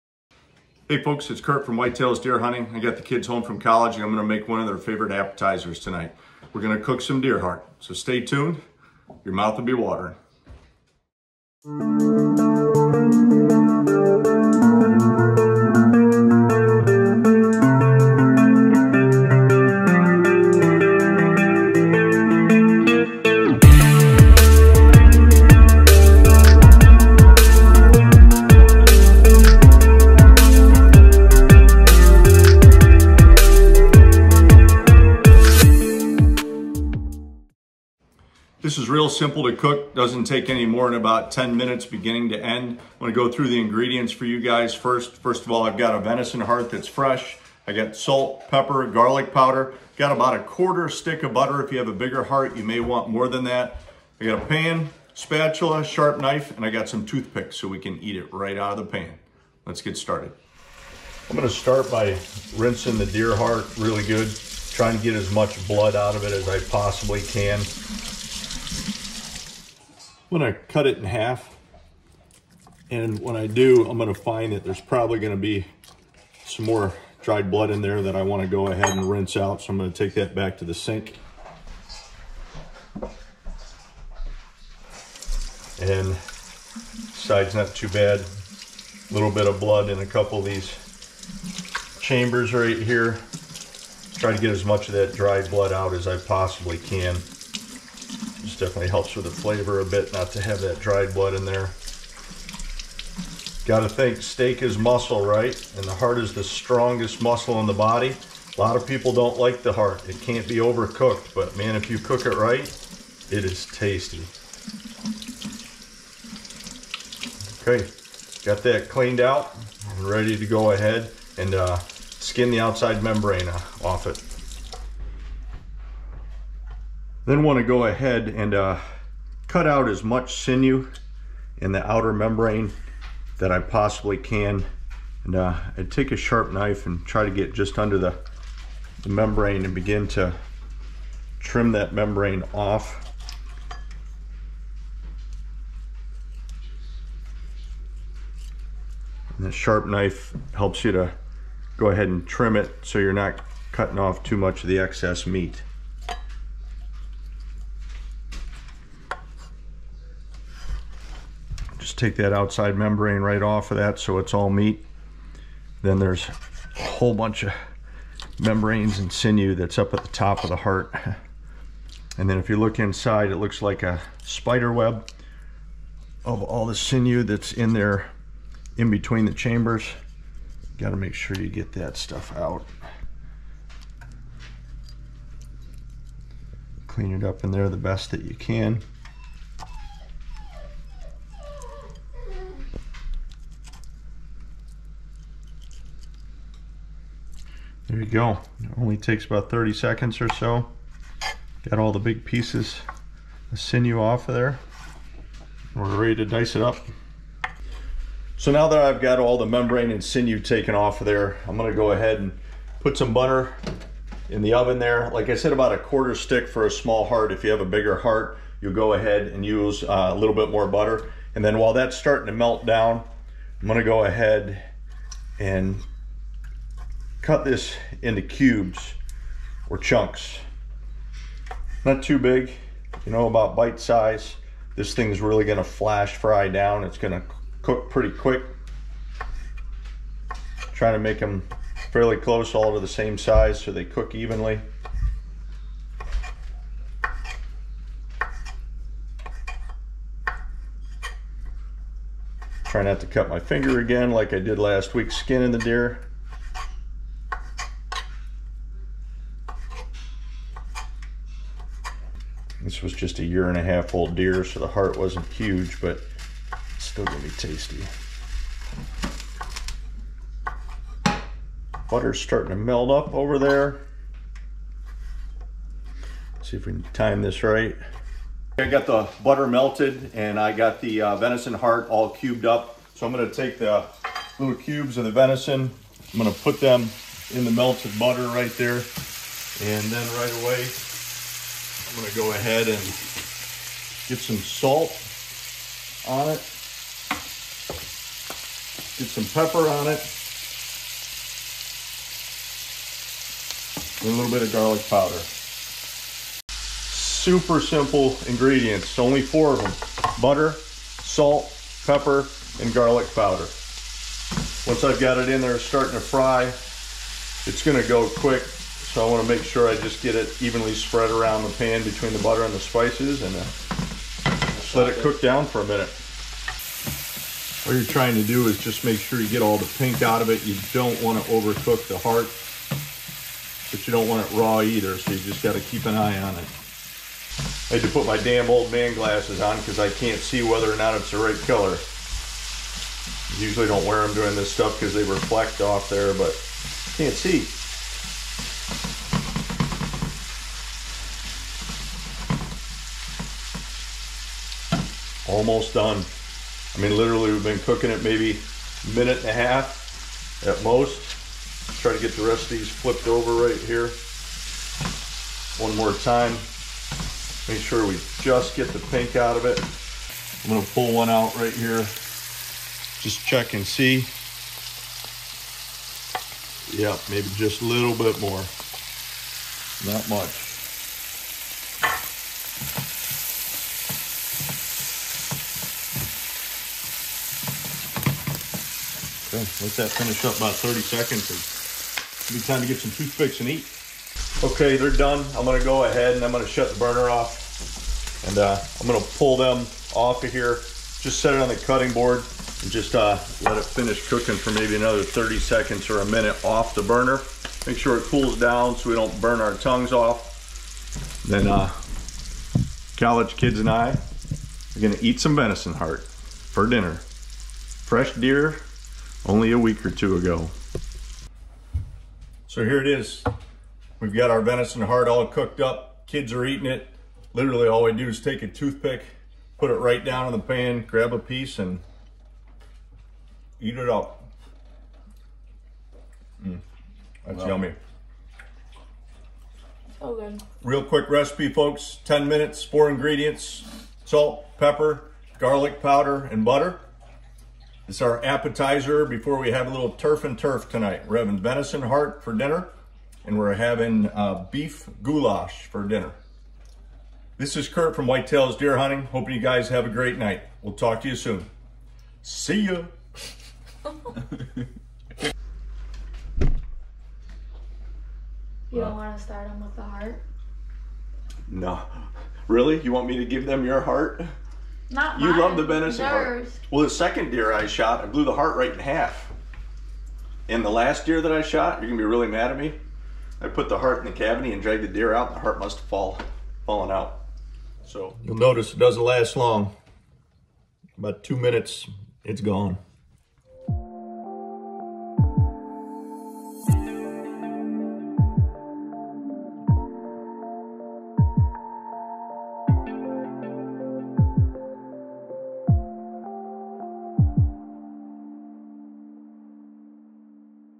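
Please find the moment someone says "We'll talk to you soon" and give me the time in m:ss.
7:40.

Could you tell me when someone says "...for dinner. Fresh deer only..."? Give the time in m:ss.
6:56.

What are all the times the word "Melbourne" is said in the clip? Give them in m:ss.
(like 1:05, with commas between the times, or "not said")
not said.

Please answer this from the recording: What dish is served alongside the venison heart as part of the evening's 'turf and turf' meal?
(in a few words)
beef goulash.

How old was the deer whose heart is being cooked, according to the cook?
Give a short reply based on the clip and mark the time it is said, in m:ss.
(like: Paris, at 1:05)
a year and a half, at 4:23.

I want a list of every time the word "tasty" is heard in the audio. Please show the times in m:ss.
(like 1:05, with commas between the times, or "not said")
1:53, 4:27.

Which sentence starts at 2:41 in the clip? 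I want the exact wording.
just take that outside membrane right off of that so it's all meat.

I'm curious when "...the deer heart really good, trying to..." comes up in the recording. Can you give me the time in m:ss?
1:02.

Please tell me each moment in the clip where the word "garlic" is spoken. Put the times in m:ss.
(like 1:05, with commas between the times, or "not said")
0:48, 5:04, 5:12, 7:25.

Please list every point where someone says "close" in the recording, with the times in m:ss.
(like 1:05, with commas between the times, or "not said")
4:02.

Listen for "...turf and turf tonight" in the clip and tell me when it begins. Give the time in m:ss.
7:29.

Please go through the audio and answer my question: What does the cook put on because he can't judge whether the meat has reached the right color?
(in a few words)
old man glasses.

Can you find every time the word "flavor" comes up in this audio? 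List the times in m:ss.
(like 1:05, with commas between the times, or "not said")
1:39.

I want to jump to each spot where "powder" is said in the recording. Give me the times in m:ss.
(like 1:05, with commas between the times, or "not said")
0:49, 5:04, 5:13, 7:25.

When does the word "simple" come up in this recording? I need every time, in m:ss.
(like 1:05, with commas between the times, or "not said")
0:39, 5:07.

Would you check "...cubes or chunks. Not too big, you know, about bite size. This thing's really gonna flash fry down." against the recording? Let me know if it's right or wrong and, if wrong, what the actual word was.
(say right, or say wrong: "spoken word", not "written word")
right.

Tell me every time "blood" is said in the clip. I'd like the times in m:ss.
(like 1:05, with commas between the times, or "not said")
1:05, 1:17, 1:29, 1:35, 1:41.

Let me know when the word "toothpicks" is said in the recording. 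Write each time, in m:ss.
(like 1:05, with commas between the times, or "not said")
0:57, 6:32, 7:08.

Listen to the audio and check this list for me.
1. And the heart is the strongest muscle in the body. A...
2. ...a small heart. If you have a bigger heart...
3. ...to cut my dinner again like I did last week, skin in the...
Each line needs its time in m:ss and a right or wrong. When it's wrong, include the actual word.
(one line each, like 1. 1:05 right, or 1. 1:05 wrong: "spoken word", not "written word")
1. 1:45 right
2. 3:36 right
3. 4:13 wrong: "finger", not "dinner".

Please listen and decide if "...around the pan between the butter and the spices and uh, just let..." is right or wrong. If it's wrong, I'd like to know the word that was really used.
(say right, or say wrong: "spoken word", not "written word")
right.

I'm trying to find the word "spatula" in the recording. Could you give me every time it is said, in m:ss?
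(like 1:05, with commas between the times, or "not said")
0:55.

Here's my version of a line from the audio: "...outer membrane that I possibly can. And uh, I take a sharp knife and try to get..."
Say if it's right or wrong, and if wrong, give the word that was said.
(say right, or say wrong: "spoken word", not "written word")
right.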